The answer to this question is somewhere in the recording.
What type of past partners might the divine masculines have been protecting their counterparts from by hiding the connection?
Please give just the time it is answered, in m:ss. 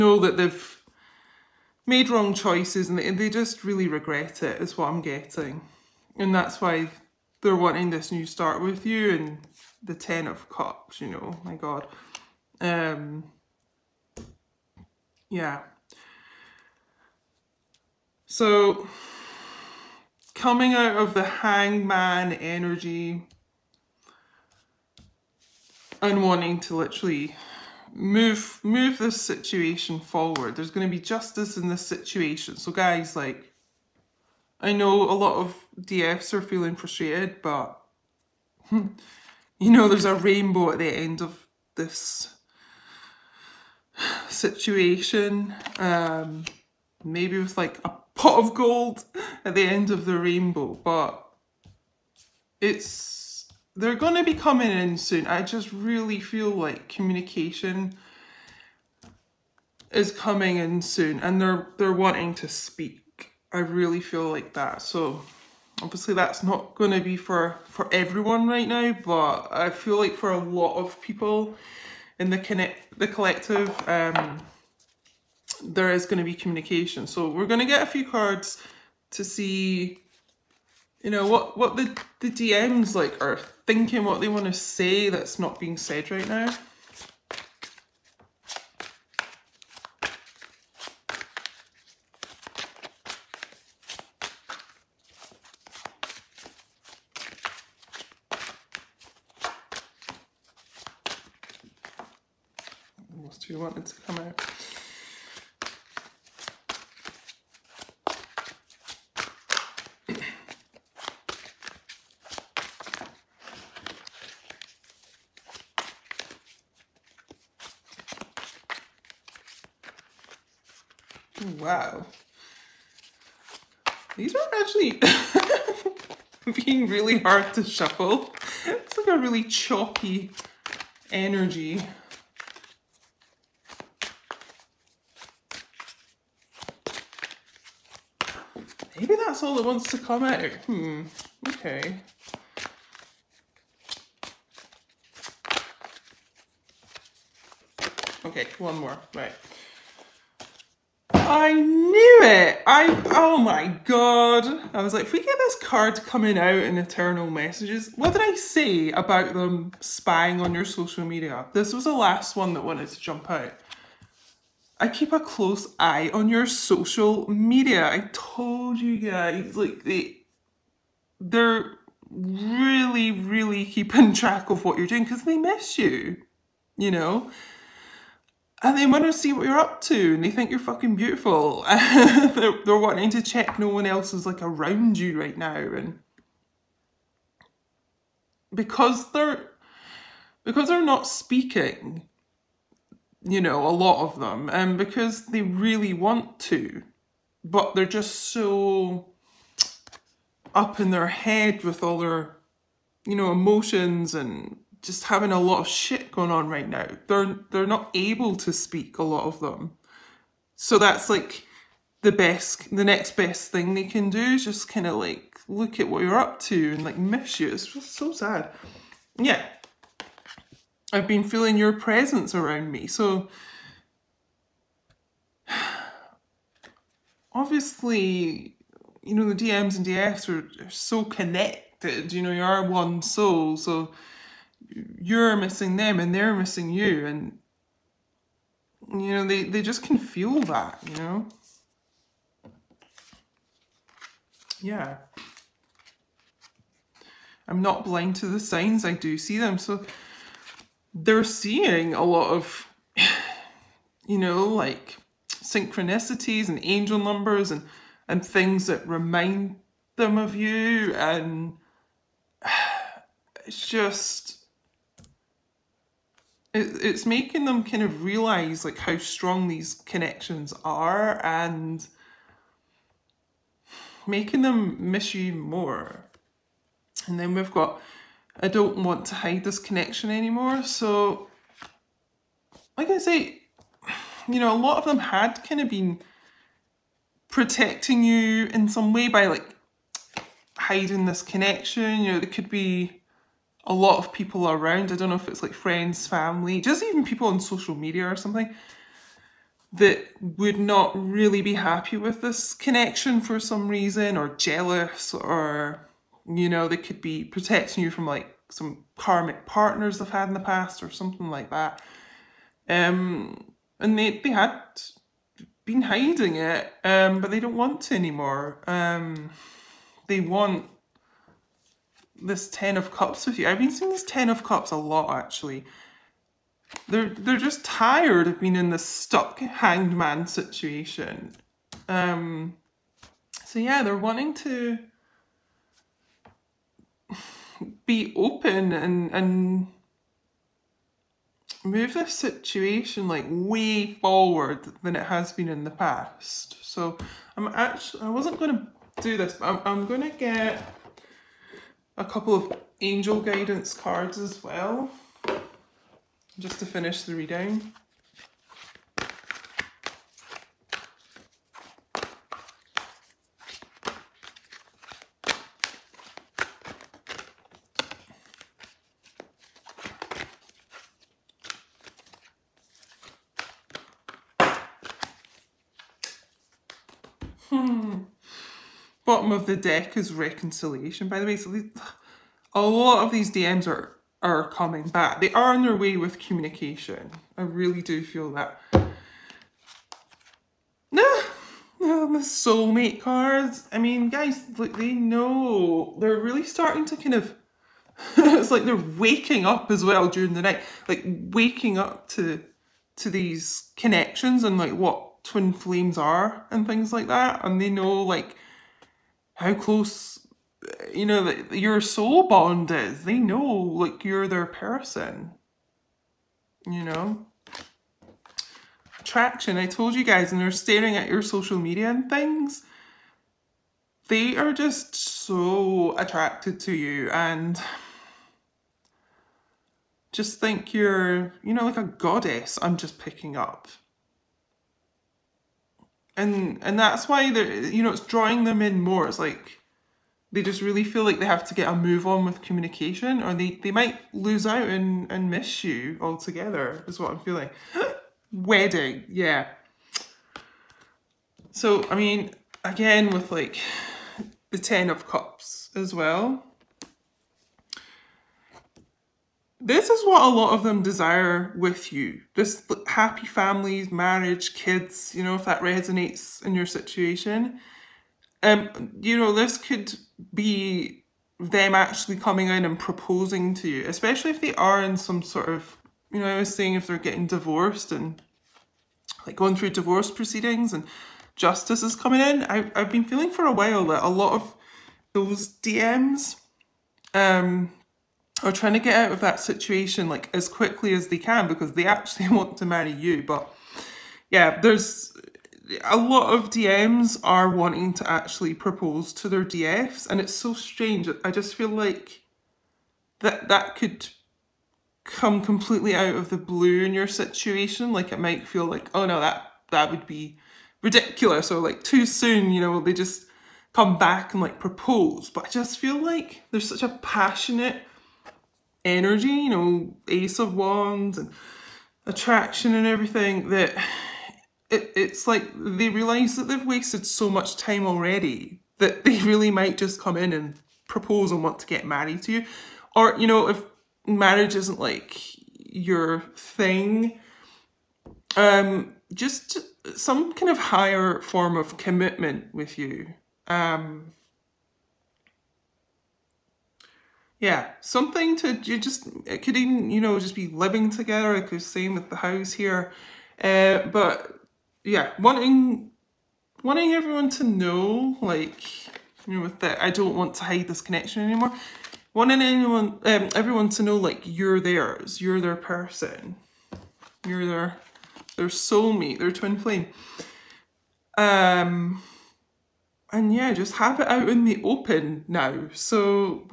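5:08.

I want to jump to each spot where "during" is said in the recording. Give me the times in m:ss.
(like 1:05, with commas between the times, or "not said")
6:40.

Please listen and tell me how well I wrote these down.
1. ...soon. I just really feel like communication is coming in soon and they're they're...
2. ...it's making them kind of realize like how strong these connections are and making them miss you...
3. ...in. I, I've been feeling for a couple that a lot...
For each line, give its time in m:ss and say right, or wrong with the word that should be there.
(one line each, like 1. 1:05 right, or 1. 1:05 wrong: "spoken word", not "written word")
1. 0:54 right
2. 4:26 right
3. 8:02 wrong: "while", not "couple".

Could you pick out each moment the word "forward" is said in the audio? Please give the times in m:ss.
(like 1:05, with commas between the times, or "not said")
0:29, 5:43.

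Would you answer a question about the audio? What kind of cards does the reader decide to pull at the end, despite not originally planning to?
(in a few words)
Angel guidance cards.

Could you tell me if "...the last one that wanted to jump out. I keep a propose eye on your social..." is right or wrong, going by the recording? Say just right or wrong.
wrong.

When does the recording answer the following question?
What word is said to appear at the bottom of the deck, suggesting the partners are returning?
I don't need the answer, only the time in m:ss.
6:20.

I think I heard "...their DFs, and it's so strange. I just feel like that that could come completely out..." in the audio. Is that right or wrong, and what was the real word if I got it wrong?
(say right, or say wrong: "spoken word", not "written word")
right.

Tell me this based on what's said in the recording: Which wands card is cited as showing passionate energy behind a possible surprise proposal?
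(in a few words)
Ace of Wands.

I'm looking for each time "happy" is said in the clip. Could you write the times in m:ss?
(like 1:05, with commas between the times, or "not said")
5:01, 7:42.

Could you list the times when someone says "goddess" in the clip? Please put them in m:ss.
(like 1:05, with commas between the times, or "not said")
7:11.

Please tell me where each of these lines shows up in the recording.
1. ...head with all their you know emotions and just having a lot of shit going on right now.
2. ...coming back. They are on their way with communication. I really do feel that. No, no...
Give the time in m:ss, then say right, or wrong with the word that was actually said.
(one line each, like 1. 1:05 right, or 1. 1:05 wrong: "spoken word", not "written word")
1. 3:21 right
2. 6:24 right.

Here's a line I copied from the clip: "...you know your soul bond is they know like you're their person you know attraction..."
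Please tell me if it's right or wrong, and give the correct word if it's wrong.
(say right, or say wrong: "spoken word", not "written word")
right.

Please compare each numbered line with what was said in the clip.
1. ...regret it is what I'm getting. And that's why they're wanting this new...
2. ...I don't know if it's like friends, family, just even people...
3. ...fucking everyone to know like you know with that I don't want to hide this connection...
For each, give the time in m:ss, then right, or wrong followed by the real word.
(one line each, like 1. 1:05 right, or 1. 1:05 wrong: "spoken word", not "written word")
1. 0:03 right
2. 4:54 right
3. 9:16 wrong: "wanting", not "fucking".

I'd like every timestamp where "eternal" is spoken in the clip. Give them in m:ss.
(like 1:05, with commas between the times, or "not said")
2:36.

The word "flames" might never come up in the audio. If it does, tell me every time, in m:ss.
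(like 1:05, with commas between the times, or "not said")
6:45, 9:29.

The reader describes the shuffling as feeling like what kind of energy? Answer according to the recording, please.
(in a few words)
Choppy.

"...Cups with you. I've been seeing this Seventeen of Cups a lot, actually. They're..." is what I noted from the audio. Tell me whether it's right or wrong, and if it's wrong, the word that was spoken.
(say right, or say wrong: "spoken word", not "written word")
wrong: "Ten", not "Seventeen".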